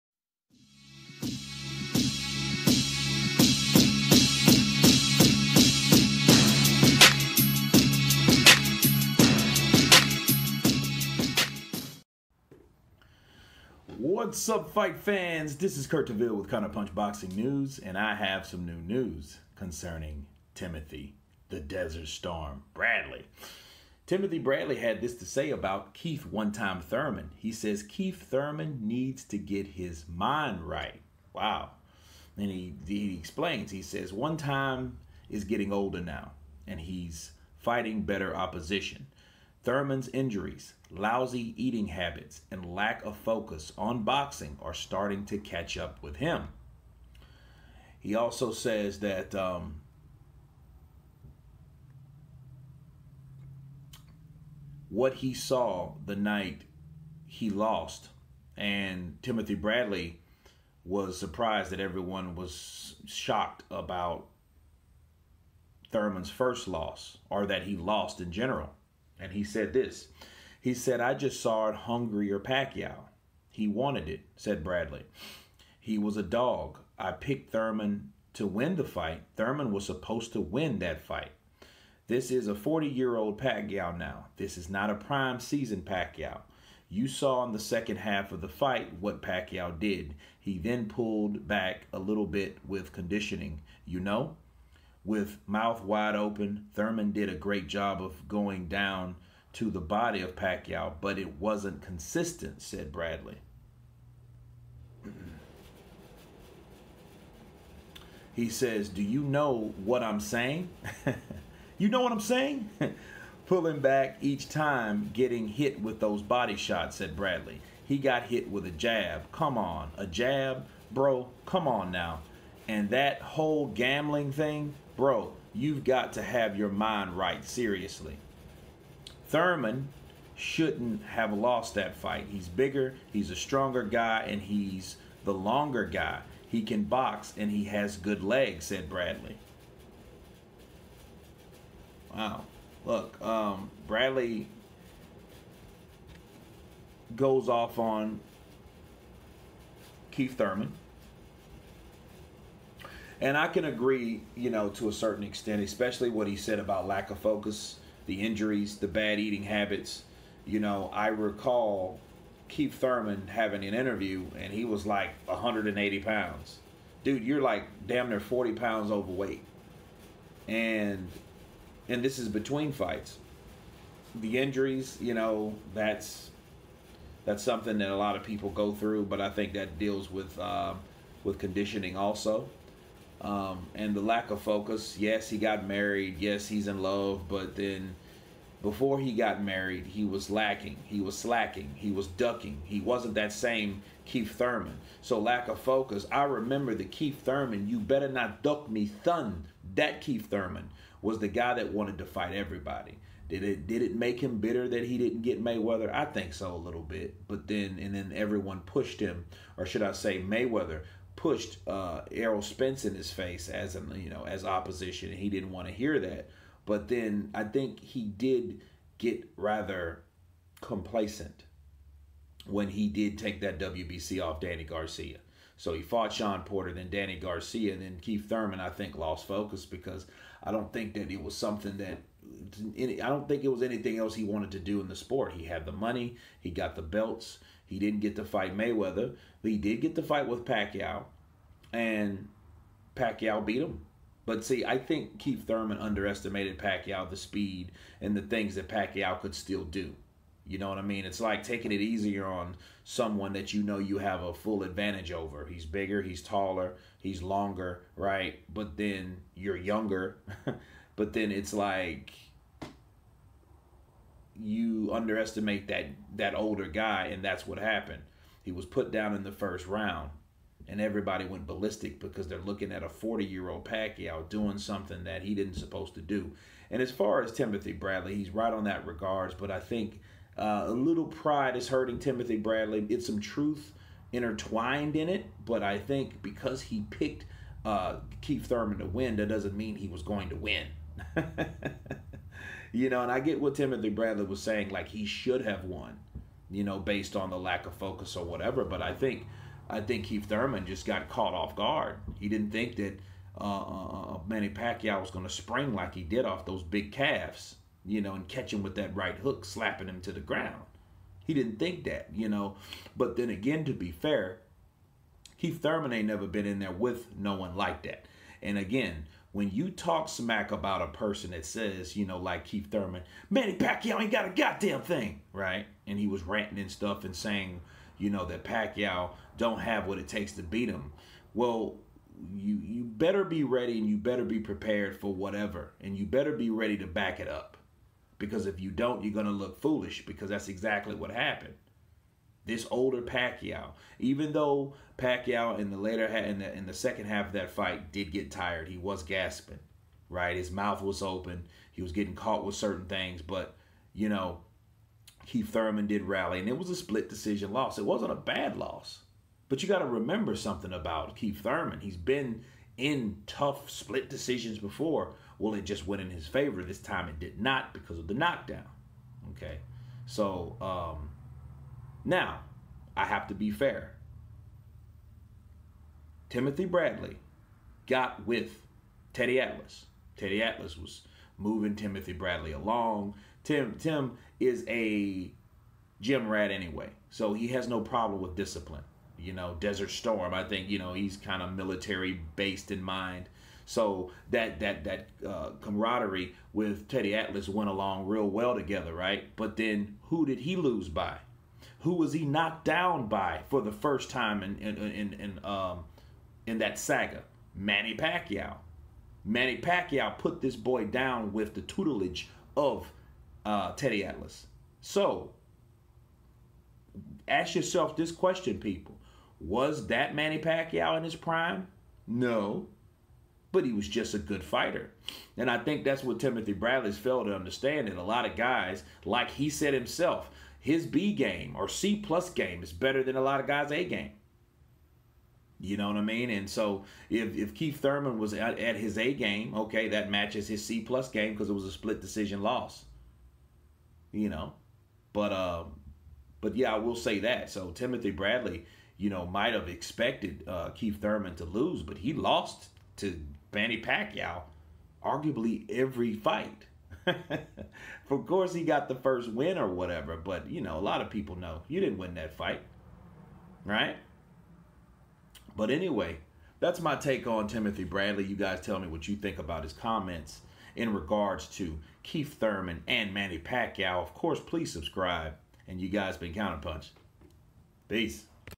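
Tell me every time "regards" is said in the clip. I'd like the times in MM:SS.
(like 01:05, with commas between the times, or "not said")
04:38, 07:50.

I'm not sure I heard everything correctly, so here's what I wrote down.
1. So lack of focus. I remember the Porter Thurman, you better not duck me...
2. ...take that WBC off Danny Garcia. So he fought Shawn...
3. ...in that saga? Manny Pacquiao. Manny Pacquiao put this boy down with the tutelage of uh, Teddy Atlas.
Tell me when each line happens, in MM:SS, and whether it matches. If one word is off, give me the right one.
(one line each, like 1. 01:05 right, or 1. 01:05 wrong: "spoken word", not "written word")
1. 03:15 wrong: "Keith", not "Porter"
2. 03:43 right
3. 06:46 right.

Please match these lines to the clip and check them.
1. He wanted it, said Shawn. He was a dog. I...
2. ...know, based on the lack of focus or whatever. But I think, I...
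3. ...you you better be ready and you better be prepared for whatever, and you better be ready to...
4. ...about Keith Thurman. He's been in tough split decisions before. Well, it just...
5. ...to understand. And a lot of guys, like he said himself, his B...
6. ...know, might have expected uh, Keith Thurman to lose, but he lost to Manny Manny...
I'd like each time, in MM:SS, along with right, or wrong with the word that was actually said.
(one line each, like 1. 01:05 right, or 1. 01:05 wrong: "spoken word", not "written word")
1. 01:13 wrong: "Bradley", not "Shawn"
2. 04:56 right
3. 05:32 right
4. 06:00 right
5. 07:07 right
6. 07:29 wrong: "Pacquiao", not "Manny".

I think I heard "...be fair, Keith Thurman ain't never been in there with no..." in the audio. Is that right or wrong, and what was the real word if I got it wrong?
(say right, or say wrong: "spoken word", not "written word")
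right.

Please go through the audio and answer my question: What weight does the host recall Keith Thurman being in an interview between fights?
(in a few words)
180 pounds.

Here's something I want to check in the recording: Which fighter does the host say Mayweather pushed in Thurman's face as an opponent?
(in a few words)
Errol Spence.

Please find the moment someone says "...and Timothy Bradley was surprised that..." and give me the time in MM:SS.
00:58.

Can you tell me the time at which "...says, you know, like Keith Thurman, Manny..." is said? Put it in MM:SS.
05:21.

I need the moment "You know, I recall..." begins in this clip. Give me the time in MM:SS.
02:40.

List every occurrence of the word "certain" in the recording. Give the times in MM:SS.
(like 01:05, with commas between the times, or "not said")
02:34, 05:52.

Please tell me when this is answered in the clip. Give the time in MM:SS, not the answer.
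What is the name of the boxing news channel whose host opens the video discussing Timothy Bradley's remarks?
00:16.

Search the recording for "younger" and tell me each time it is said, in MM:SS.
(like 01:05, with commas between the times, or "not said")
04:19.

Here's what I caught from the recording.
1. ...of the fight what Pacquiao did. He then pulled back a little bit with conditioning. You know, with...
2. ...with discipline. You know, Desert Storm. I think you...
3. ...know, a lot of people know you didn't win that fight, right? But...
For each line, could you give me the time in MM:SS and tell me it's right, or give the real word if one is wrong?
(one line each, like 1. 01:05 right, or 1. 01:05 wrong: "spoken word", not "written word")
1. 01:28 right
2. 06:28 right
3. 07:40 right.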